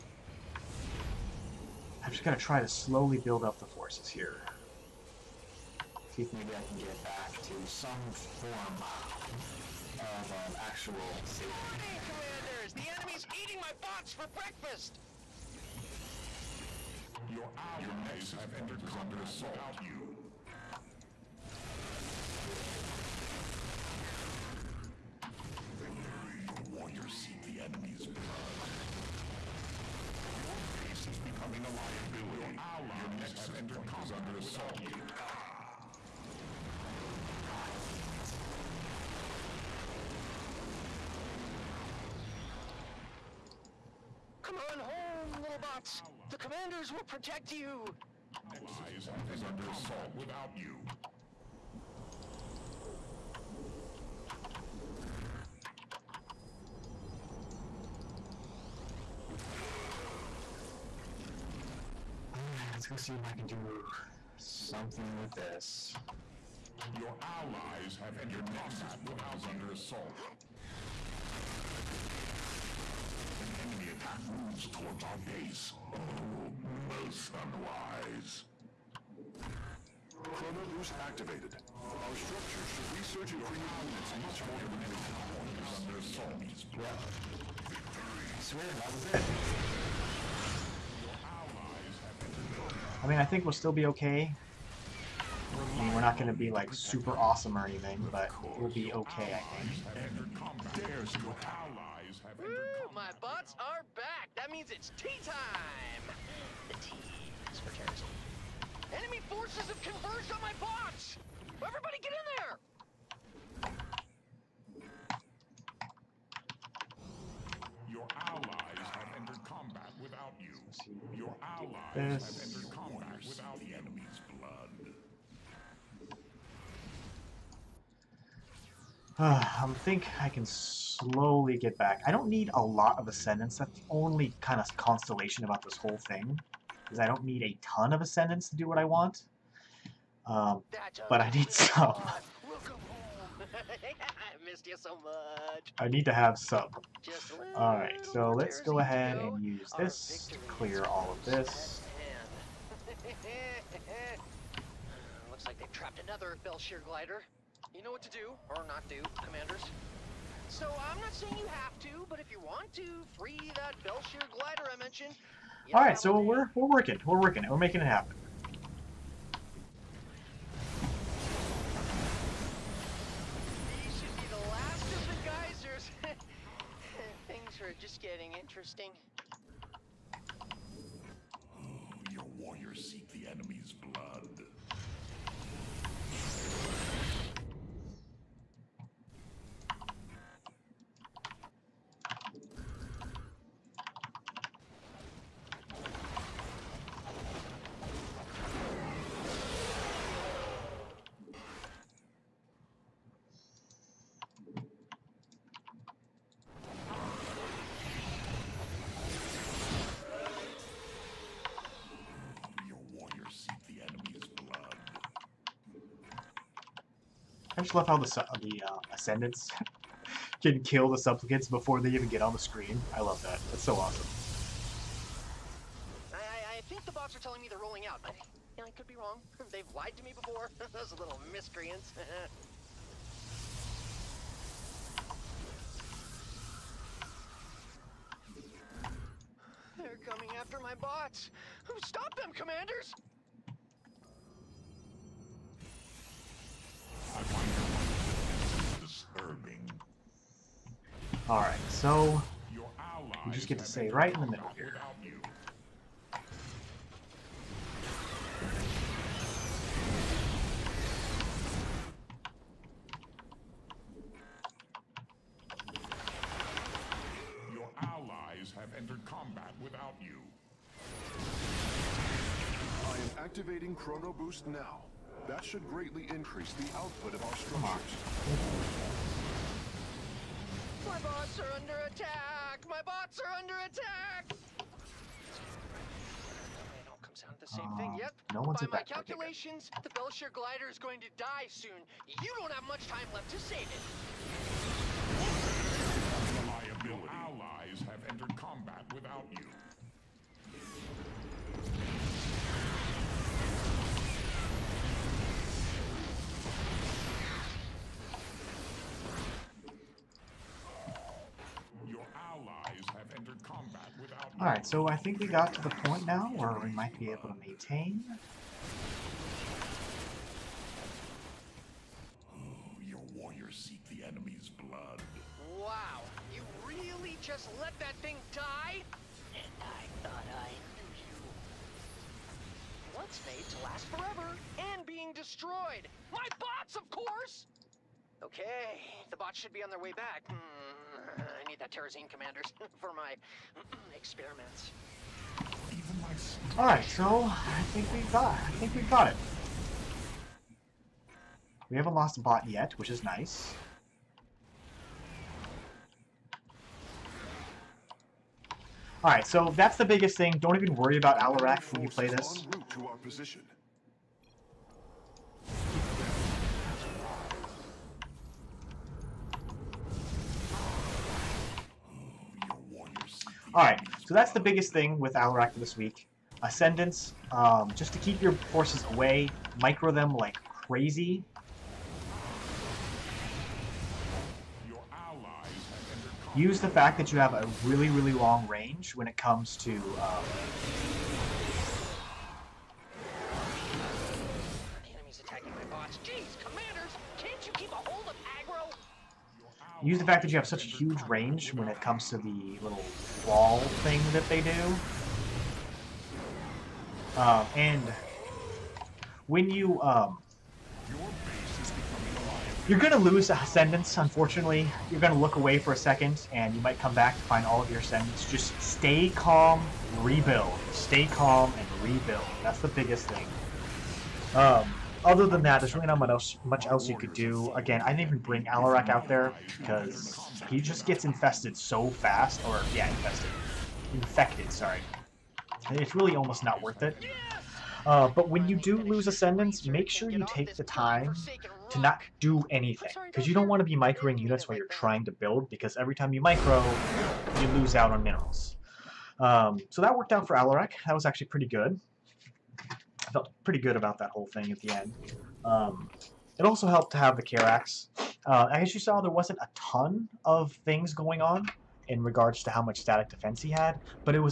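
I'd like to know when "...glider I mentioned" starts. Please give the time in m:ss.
2:44.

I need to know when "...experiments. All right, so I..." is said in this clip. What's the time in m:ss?
5:43.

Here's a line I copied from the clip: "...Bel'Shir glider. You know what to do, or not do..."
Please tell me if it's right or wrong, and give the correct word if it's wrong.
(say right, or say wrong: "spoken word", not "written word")
right.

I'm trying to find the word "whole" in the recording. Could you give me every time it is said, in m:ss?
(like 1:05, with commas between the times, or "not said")
2:15, 7:34.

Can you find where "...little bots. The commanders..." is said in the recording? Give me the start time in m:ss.
0:45.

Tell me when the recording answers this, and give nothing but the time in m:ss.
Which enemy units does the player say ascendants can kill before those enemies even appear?
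3:40.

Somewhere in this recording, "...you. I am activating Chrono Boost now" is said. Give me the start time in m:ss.
4:30.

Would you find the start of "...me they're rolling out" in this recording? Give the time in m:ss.
3:47.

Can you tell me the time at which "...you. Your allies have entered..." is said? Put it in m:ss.
2:00.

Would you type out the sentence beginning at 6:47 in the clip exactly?
Uh, and when you um, you're gonna lose ascendants, unfortunately.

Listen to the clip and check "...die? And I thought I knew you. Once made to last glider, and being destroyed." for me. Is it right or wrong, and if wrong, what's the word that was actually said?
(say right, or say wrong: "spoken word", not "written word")
wrong: "forever", not "glider".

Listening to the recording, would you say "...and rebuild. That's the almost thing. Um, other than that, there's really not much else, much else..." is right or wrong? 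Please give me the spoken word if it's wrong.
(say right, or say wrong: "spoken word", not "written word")
wrong: "biggest", not "almost".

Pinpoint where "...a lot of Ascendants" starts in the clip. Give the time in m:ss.
2:12.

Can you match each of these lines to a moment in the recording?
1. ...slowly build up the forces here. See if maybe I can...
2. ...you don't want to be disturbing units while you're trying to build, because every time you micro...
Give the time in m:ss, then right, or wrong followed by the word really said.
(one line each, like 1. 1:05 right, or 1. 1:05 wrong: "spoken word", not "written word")
1. 0:02 right
2. 7:23 wrong: "microing", not "disturbing".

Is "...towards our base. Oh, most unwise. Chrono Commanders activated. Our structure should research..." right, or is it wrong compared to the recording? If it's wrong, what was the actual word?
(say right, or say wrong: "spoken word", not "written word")
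wrong: "Boost", not "Commanders".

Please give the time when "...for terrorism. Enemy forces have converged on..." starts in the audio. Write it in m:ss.
1:47.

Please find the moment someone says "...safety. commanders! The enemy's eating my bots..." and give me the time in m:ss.
0:11.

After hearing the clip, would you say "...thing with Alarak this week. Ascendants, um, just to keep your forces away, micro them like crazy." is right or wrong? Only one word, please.
right.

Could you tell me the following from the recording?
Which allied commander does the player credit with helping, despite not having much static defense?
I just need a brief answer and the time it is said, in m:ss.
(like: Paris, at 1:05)
Karax, at 7:37.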